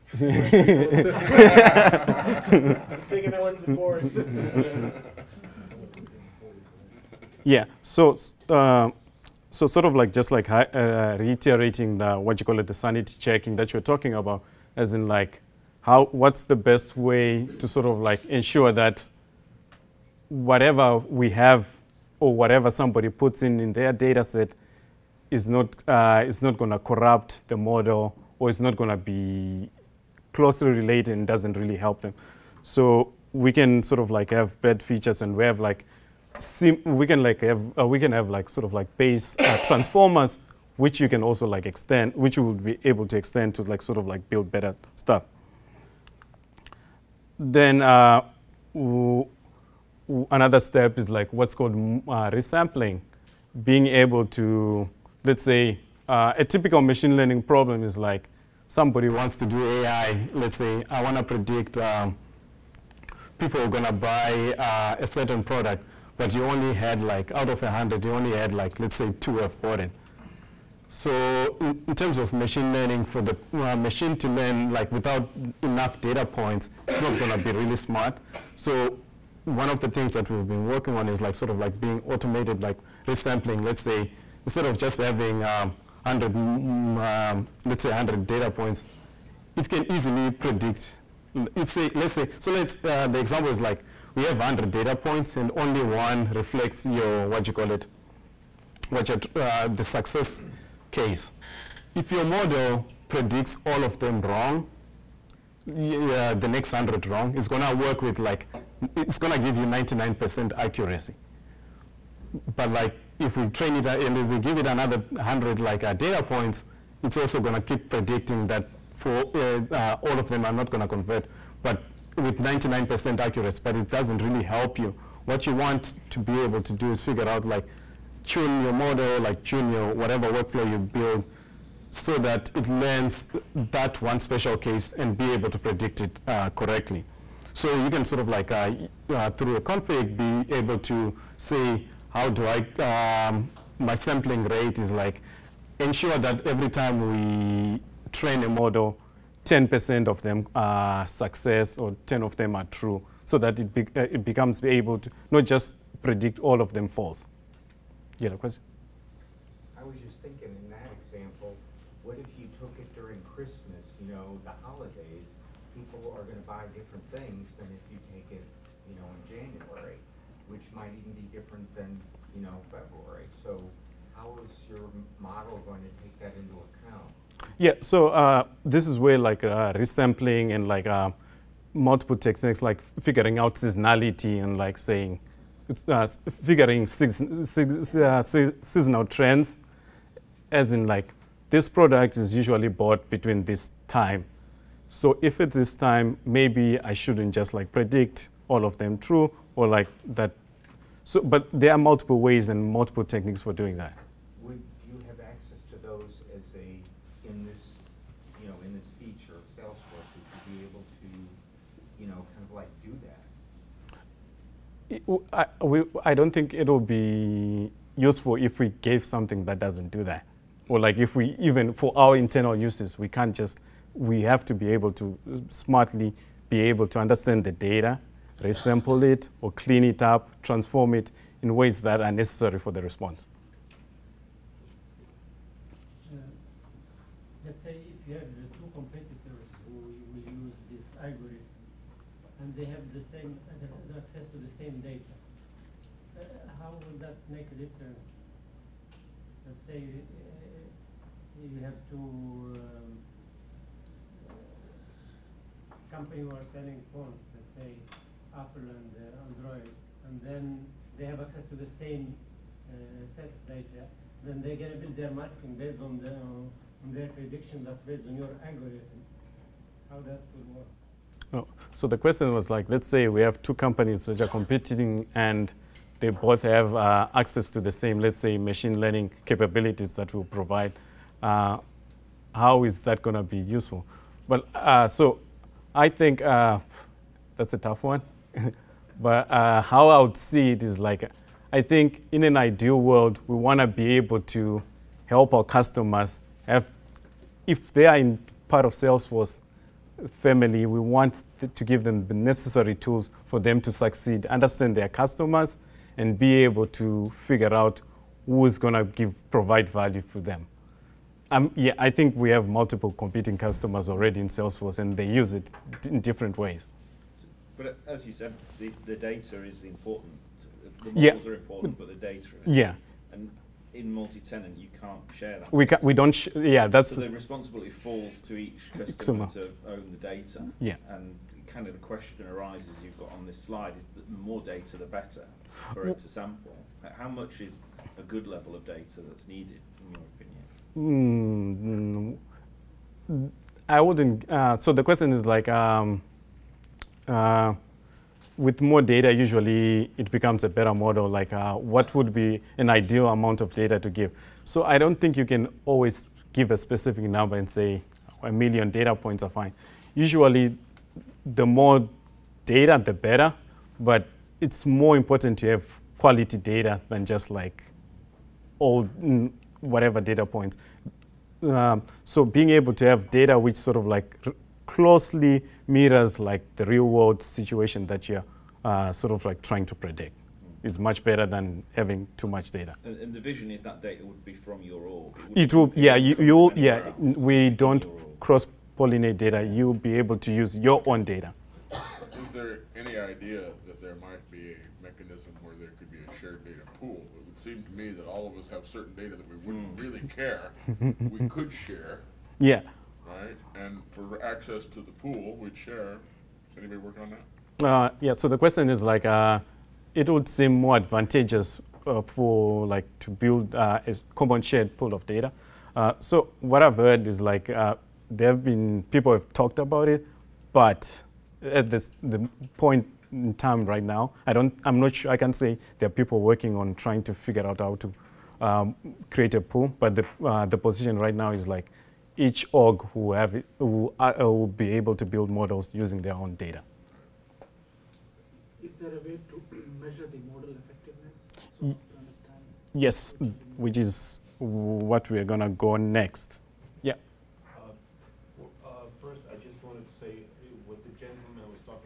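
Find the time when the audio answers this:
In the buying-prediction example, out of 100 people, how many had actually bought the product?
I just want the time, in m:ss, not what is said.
1:09.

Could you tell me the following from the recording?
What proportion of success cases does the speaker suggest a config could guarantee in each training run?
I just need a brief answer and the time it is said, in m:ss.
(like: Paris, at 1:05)
10%, at 2:29.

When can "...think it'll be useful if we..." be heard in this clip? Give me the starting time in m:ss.
3:36.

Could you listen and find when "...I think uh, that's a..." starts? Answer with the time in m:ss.
4:45.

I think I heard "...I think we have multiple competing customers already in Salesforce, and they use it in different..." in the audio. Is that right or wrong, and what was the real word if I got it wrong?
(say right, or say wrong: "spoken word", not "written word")
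right.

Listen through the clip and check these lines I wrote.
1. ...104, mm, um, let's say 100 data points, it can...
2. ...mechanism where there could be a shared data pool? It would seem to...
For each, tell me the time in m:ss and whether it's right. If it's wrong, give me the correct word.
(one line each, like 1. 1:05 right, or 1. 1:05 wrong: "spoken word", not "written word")
1. 1:26 wrong: "100", not "104"
2. 6:34 right.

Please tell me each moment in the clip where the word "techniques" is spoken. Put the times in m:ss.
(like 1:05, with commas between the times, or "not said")
3:02, 3:23.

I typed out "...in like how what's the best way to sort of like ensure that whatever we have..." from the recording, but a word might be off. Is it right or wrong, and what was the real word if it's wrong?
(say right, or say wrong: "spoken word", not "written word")
right.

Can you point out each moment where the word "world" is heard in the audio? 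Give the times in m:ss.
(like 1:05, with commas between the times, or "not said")
4:52, 6:16.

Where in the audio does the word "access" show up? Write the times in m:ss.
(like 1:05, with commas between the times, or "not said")
3:25, 4:03, 4:21, 4:37, 6:44.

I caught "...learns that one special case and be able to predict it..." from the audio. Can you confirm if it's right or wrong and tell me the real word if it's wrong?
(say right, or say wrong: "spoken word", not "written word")
right.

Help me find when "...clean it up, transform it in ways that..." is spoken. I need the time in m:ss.
3:49.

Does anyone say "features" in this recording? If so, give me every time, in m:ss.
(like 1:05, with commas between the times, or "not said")
0:34, 3:28.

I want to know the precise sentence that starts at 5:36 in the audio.
How much is a good level of data that's needed, in your opinion?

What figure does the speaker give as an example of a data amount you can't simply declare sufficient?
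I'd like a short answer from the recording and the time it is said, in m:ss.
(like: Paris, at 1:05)
a million data points, at 5:58.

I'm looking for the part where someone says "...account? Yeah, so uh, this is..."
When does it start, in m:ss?
2:56.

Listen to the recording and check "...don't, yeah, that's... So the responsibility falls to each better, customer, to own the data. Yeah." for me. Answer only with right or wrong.
wrong.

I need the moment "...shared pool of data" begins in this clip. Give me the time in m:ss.
6:54.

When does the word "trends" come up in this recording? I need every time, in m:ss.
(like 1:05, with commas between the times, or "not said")
3:09.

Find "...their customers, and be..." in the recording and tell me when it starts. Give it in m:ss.
5:04.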